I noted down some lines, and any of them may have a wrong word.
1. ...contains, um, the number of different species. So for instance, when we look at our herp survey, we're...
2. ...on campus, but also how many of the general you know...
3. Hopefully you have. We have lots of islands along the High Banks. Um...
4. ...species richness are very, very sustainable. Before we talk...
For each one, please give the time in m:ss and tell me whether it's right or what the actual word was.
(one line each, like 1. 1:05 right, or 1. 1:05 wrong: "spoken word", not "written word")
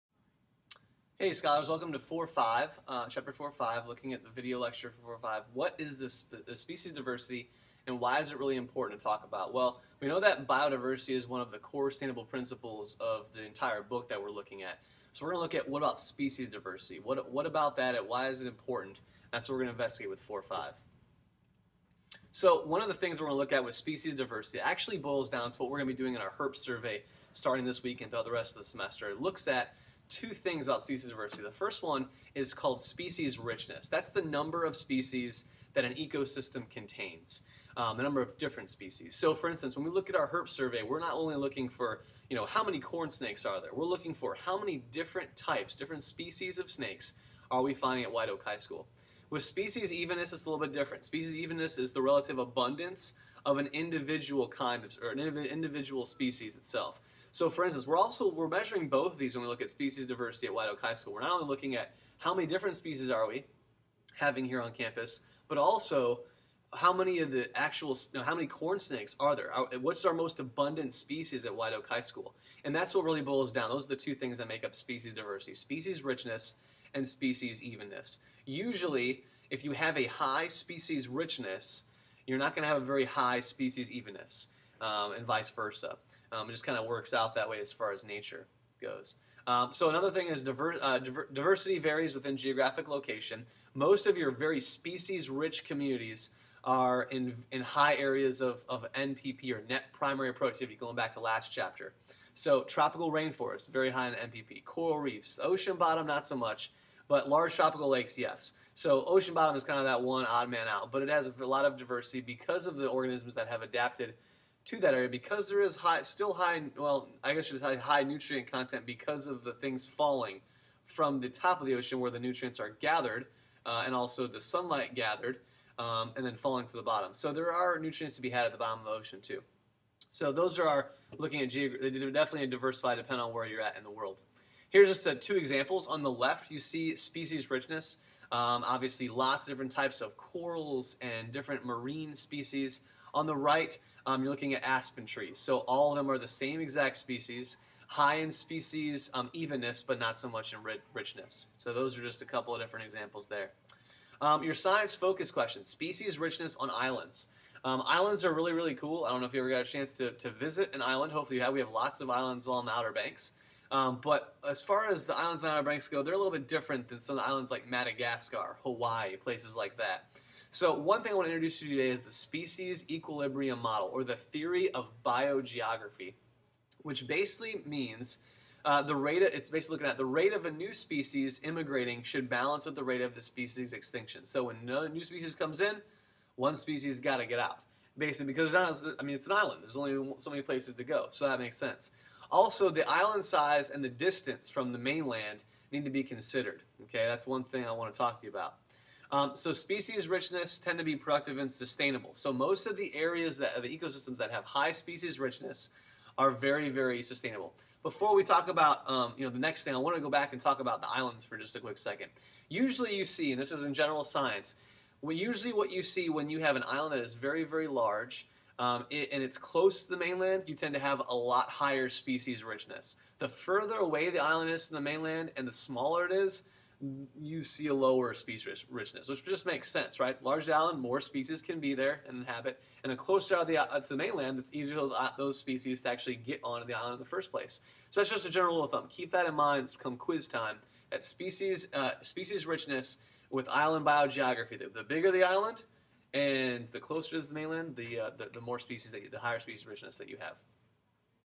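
1. 0:36 right
2. 1:04 wrong: "actual", not "general"
3. 2:41 wrong: "Outer", not "High"
4. 3:24 right.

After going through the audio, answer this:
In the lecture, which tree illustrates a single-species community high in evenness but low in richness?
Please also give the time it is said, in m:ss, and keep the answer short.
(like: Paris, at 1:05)
Aspen trees, at 2:24.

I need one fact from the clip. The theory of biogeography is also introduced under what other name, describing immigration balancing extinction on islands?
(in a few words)
Species equilibrium model.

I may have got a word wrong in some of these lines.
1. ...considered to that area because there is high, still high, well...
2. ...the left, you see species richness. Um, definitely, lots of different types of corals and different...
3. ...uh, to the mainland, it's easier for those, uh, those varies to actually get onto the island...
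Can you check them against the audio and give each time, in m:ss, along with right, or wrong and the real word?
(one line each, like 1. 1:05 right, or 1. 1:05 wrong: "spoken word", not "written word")
1. 1:53 wrong: "adapted", not "considered"
2. 2:16 wrong: "obviously", not "definitely"
3. 3:53 wrong: "species", not "varies".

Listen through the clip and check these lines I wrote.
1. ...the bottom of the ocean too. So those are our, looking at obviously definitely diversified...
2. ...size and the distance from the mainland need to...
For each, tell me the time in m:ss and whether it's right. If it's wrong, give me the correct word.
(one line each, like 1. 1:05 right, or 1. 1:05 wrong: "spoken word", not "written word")
1. 2:08 wrong: "geographically", not "obviously"
2. 3:13 right.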